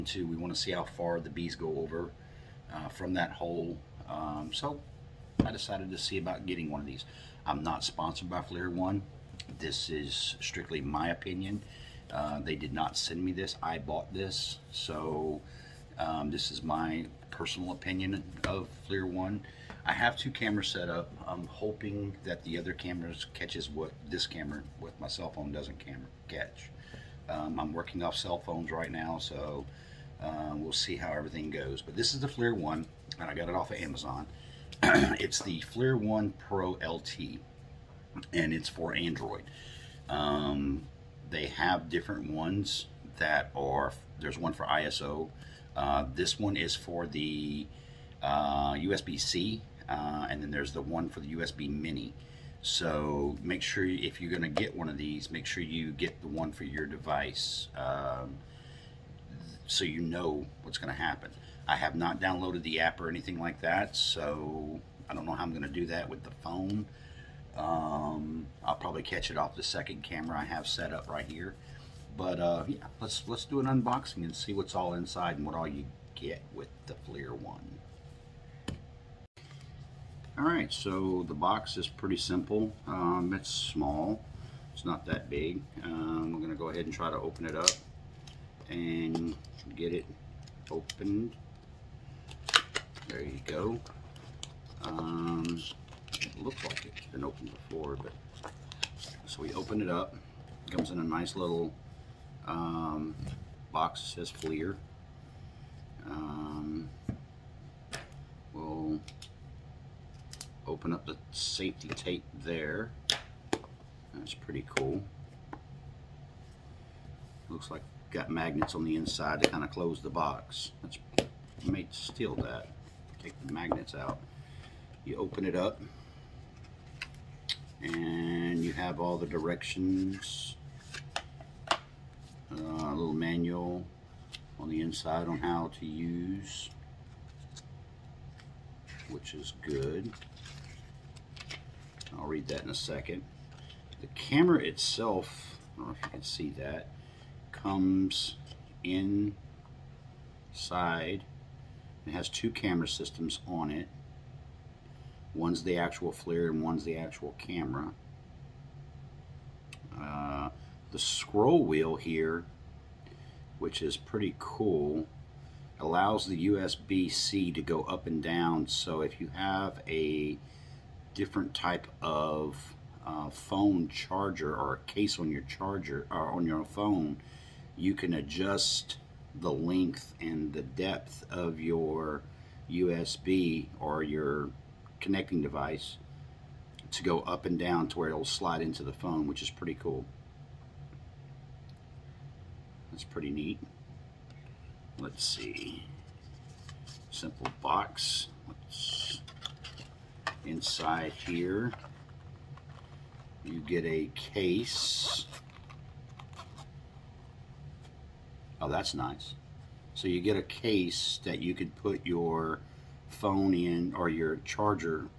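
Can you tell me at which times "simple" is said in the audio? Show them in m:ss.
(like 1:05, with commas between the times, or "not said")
1:22, 3:17.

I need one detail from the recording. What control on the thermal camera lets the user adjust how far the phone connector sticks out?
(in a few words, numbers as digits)
scroll wheel.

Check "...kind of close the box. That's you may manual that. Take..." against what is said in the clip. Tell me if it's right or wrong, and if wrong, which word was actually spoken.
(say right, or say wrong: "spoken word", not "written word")
wrong: "steal", not "manual".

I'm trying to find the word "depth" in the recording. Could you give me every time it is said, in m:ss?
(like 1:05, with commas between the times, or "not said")
3:00.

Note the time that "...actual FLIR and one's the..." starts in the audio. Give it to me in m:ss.
2:35.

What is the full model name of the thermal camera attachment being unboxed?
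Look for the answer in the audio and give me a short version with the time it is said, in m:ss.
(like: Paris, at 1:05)
FLIR 1 Pro LT, at 0:35.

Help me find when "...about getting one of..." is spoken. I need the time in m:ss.
0:06.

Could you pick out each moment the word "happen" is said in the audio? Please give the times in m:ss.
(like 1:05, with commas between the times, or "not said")
1:01.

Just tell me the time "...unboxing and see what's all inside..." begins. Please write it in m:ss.
1:13.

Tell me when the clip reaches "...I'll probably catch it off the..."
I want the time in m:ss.
1:08.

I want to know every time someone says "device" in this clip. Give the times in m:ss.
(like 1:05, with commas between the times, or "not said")
0:56, 3:05.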